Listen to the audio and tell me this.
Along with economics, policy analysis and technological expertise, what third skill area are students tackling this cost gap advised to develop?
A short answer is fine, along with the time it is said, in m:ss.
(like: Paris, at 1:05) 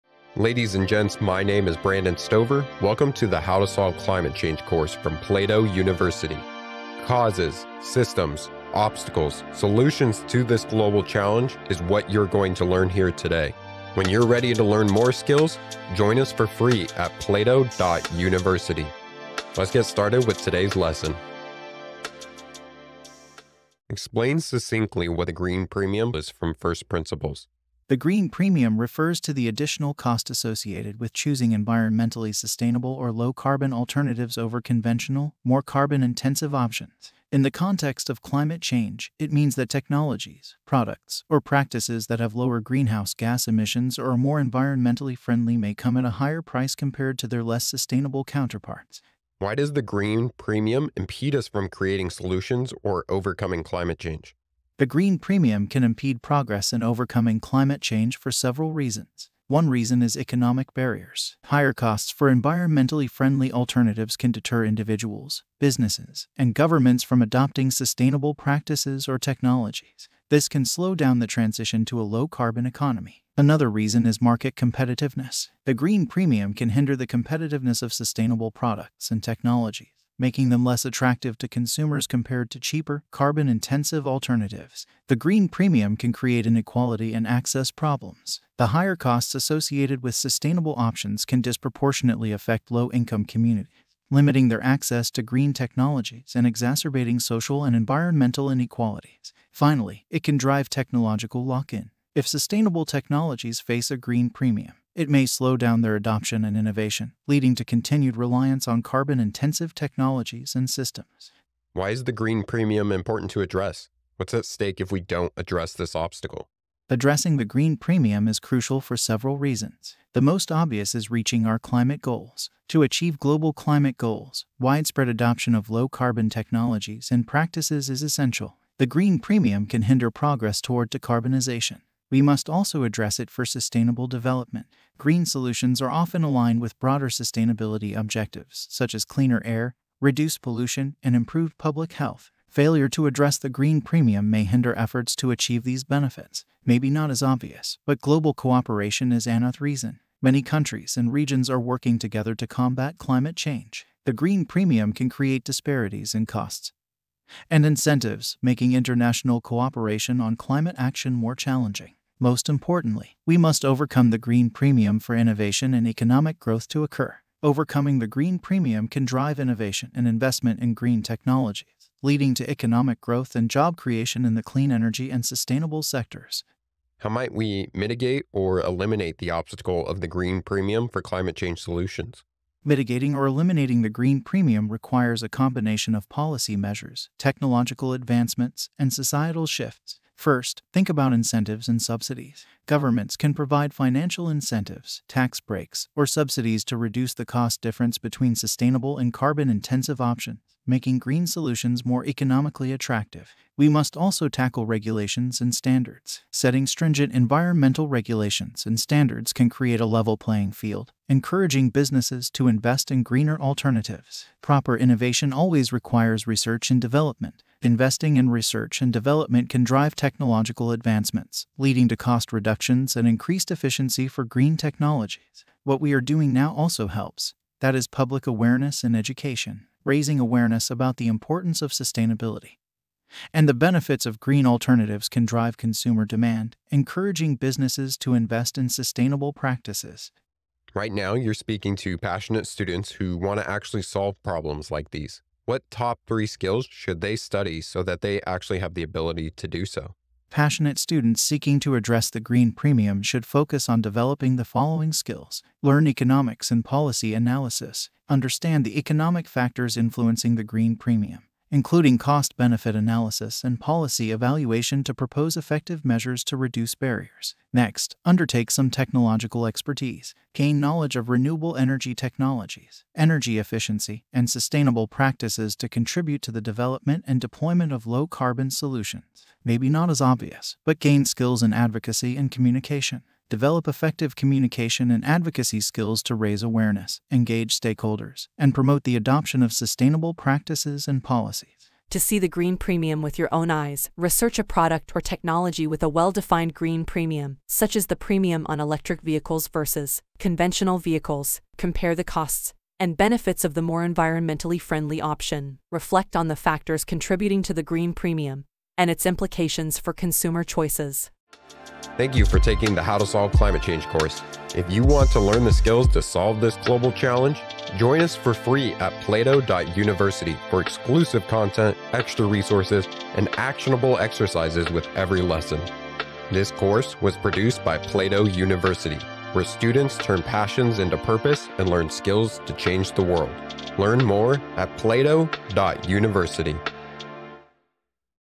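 Advocacy and communication, at 4:41.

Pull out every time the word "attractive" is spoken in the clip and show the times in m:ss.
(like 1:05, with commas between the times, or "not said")
1:20, 3:22.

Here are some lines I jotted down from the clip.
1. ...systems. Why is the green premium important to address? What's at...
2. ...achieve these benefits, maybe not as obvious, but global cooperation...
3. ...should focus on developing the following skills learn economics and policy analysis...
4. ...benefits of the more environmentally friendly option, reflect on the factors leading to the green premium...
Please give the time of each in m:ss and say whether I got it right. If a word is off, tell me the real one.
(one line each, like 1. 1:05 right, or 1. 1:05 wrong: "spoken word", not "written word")
1. 1:50 right
2. 2:25 right
3. 4:13 right
4. 5:02 wrong: "contributing", not "leading".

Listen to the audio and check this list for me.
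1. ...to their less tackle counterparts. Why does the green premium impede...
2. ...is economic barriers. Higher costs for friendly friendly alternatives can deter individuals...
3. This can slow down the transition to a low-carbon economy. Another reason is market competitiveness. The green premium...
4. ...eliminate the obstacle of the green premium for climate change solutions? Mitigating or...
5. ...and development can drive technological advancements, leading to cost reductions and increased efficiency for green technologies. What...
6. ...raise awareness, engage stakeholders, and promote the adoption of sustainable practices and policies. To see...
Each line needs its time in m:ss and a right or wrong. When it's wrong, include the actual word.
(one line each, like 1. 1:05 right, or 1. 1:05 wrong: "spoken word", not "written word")
1. 0:47 wrong: "sustainable", not "tackle"
2. 1:00 wrong: "environmentally", not "friendly"
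3. 1:10 right
4. 2:58 right
5. 3:38 right
6. 4:46 right.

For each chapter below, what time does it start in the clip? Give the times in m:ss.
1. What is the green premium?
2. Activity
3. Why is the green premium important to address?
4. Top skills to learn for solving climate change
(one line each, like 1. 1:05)
1. 0:24
2. 4:51
3. 1:51
4. 4:00.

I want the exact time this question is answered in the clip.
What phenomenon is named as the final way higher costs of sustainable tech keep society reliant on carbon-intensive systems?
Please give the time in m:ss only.
1:40.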